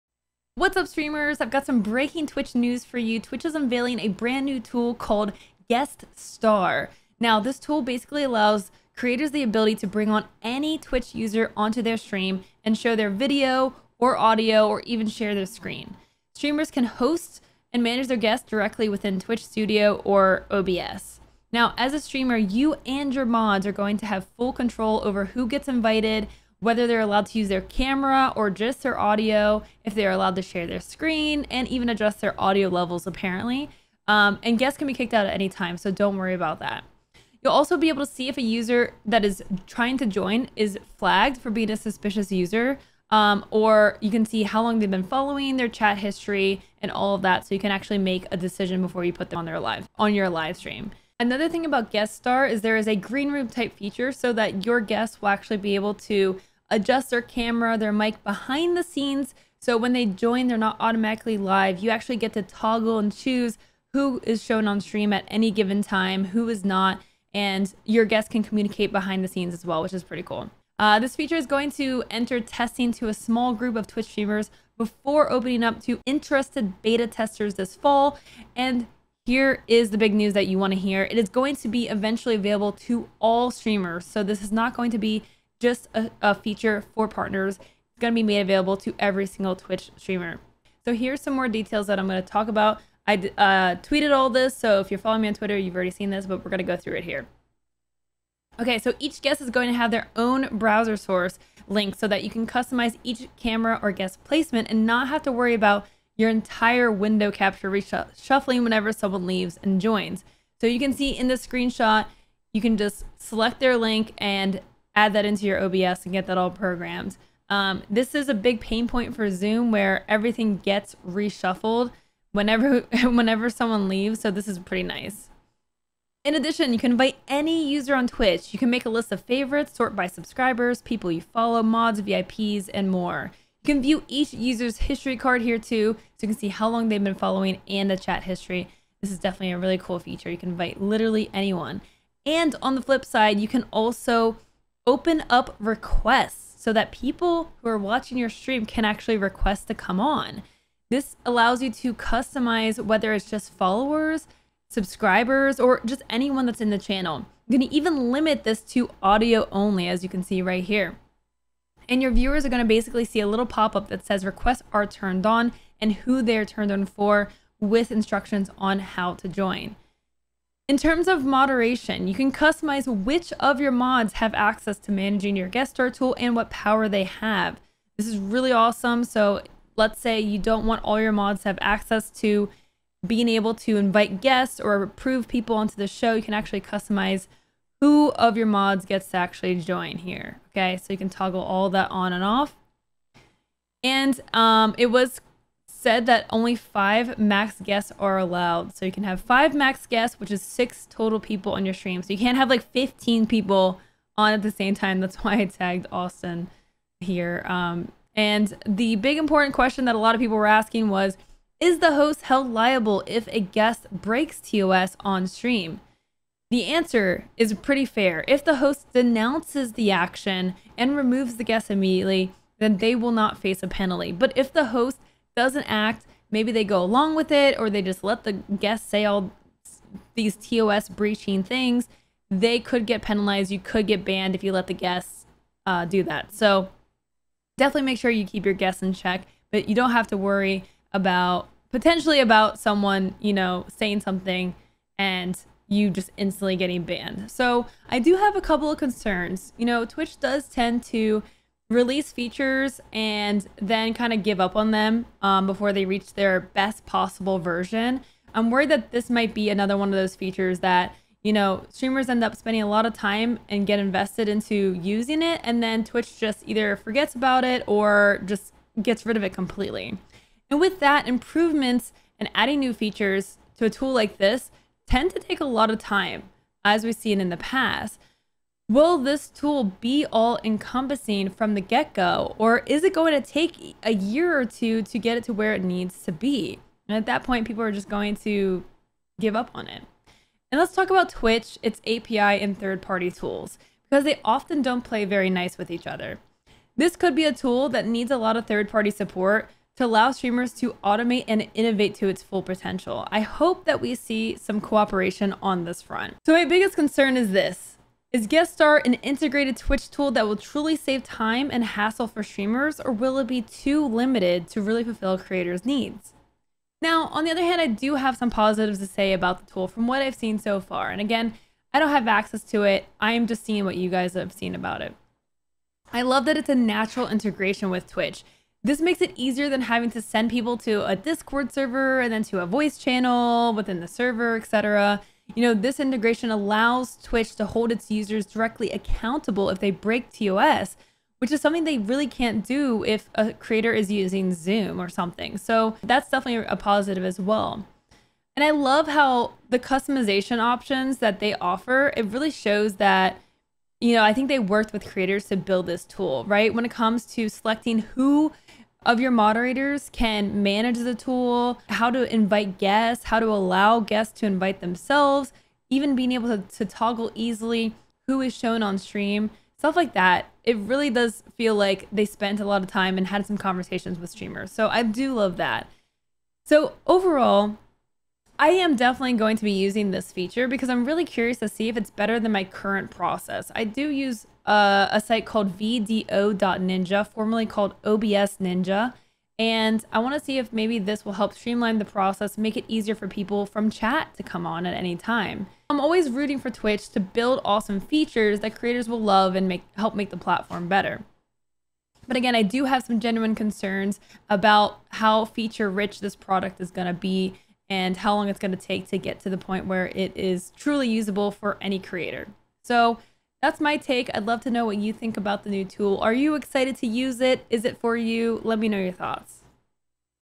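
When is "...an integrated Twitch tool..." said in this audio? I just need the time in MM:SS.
05:08.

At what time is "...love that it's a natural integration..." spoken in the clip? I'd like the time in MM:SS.
05:26.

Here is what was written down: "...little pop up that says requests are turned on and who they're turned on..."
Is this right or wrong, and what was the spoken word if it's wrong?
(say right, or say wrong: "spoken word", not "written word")
right.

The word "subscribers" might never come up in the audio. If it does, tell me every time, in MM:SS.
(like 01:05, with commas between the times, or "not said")
02:10, 02:34.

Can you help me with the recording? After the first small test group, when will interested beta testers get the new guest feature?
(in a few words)
this fall.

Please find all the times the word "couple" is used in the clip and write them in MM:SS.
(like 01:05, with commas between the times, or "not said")
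04:08.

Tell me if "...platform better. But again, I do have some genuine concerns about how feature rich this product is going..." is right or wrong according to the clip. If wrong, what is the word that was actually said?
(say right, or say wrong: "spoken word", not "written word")
right.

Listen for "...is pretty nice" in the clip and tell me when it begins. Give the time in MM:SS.
02:04.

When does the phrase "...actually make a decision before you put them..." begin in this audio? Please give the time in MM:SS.
00:47.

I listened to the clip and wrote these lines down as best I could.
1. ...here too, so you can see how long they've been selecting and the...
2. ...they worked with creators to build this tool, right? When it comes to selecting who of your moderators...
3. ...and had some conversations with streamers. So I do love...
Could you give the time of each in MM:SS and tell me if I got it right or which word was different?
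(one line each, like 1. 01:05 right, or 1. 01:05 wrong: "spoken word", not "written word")
1. 02:15 wrong: "following", not "selecting"
2. 05:54 right
3. 06:12 right.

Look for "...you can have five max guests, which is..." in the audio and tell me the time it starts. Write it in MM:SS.
03:18.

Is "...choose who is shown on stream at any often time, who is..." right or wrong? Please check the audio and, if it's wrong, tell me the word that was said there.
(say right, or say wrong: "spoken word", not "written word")
wrong: "given", not "often".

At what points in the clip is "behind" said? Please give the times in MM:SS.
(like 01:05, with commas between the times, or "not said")
00:58, 01:08.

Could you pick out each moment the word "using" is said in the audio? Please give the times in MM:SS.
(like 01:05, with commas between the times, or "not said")
04:24, 05:43, 06:19.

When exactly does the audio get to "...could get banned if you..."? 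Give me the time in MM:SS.
03:53.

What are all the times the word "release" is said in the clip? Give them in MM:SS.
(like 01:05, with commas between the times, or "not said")
04:11.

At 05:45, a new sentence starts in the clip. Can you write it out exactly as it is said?
So that's definitely a positive as well.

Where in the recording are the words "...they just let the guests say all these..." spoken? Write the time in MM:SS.
03:47.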